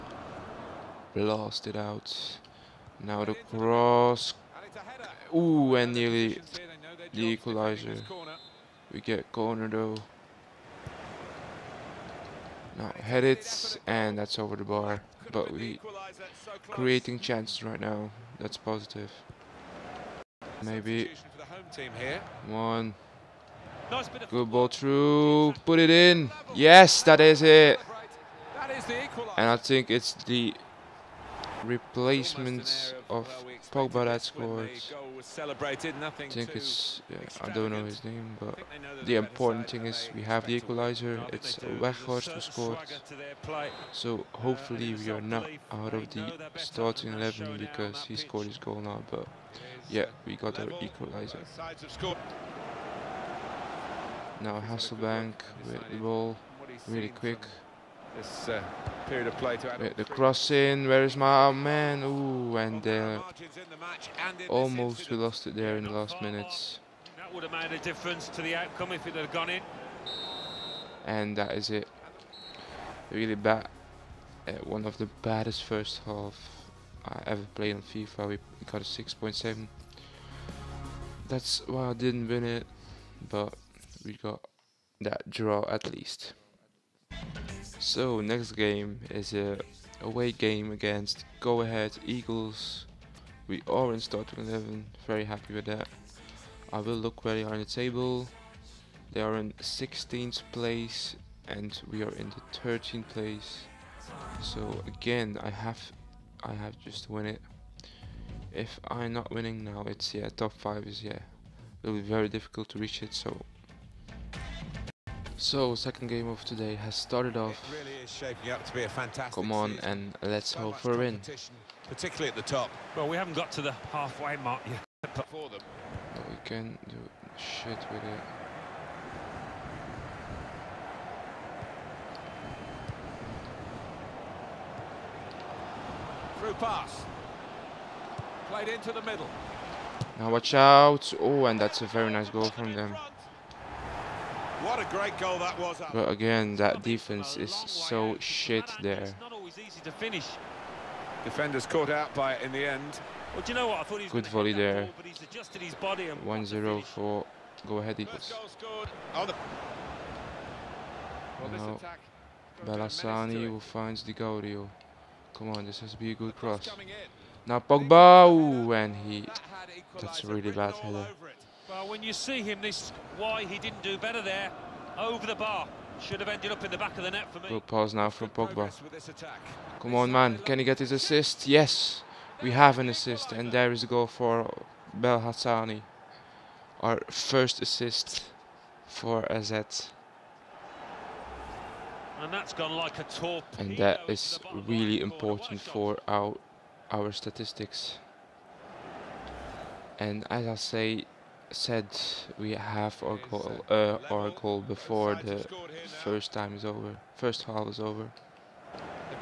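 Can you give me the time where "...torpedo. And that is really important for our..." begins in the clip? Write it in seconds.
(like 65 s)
193 s.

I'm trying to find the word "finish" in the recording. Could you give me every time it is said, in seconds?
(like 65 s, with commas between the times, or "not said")
149 s.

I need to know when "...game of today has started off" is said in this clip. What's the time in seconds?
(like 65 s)
116 s.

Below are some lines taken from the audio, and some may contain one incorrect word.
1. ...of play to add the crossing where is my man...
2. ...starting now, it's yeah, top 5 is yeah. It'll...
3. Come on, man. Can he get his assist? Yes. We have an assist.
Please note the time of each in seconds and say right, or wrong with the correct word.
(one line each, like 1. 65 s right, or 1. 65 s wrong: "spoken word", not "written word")
1. 59 s right
2. 109 s wrong: "winning", not "starting"
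3. 179 s right.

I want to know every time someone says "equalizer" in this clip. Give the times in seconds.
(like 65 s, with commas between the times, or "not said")
7 s, 40 s, 50 s.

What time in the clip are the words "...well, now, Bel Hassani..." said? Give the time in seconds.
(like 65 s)
161 s.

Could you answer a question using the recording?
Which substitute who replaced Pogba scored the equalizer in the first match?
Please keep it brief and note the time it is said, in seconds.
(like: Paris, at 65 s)
Weghorst, at 41 s.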